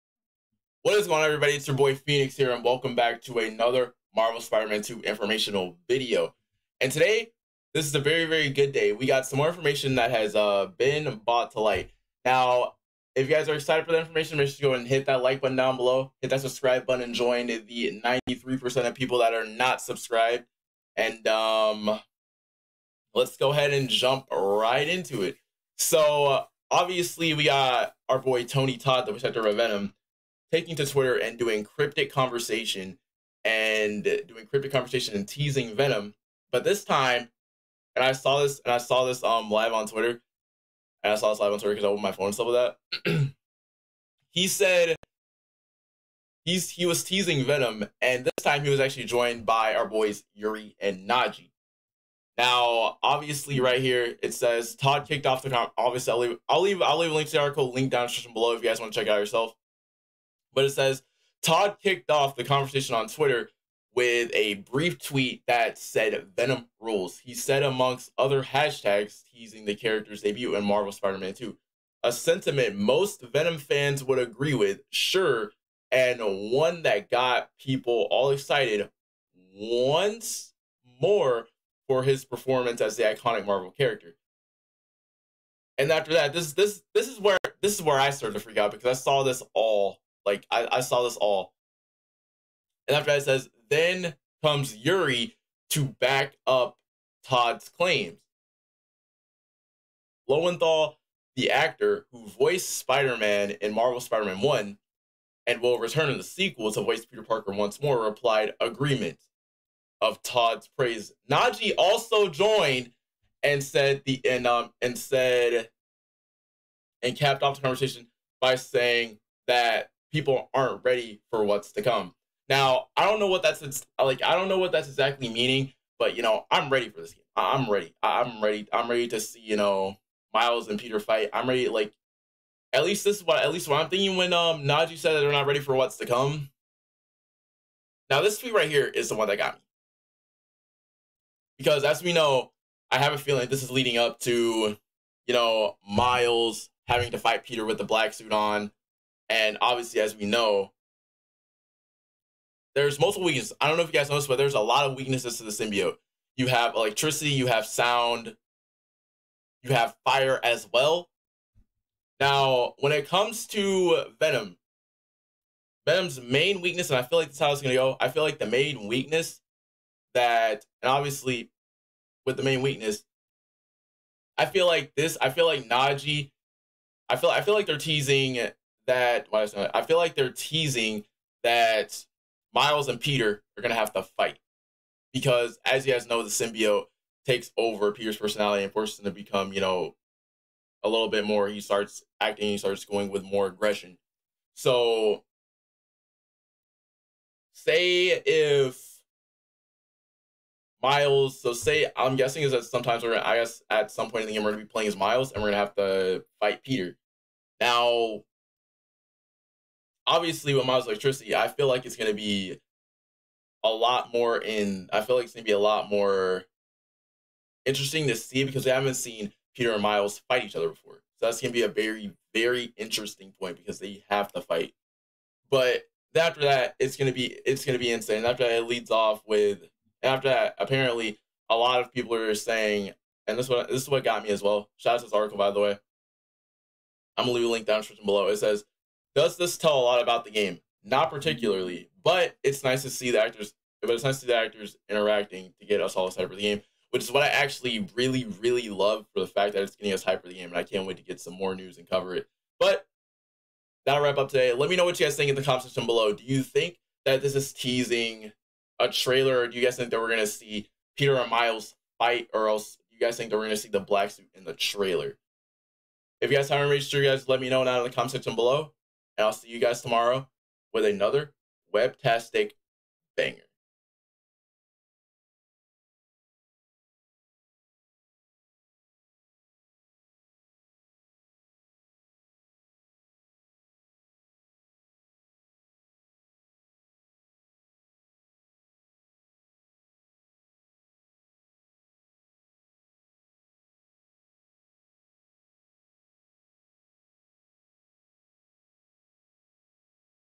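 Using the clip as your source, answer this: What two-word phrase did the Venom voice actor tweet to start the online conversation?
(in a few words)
Venom rules.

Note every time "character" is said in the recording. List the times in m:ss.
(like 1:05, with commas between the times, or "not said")
1:09, 1:23.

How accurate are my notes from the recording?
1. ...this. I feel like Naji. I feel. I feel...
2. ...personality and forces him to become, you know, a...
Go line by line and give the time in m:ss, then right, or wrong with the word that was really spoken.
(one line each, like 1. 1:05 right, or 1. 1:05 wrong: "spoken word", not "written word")
1. 2:54 wrong: "Nadji", not "Naji"
2. 3:08 right.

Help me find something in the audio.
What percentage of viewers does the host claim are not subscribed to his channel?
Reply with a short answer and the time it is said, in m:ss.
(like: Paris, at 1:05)
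93%, at 0:18.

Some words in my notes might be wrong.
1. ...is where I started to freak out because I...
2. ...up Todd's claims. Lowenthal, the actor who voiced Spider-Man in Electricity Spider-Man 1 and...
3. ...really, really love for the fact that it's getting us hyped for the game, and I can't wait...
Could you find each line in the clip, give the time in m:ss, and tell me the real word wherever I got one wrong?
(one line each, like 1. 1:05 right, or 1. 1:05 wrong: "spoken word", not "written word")
1. 1:27 right
2. 1:36 wrong: "Marvel", not "Electricity"
3. 4:07 right.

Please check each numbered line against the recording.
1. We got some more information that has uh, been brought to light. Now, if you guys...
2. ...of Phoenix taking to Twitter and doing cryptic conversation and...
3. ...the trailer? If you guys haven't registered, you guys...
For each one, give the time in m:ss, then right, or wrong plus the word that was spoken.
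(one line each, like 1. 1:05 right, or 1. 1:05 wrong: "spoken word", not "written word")
1. 0:08 right
2. 0:29 wrong: "Venom", not "Phoenix"
3. 4:24 right.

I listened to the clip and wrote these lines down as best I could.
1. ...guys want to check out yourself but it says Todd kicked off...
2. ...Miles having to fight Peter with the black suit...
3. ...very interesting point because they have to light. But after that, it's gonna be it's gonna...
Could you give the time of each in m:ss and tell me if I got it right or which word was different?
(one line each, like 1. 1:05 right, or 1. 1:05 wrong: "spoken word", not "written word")
1. 0:58 right
2. 2:25 right
3. 3:42 wrong: "fight", not "light".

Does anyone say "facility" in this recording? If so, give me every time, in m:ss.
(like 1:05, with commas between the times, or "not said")
not said.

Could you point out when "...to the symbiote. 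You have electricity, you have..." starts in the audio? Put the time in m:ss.
2:35.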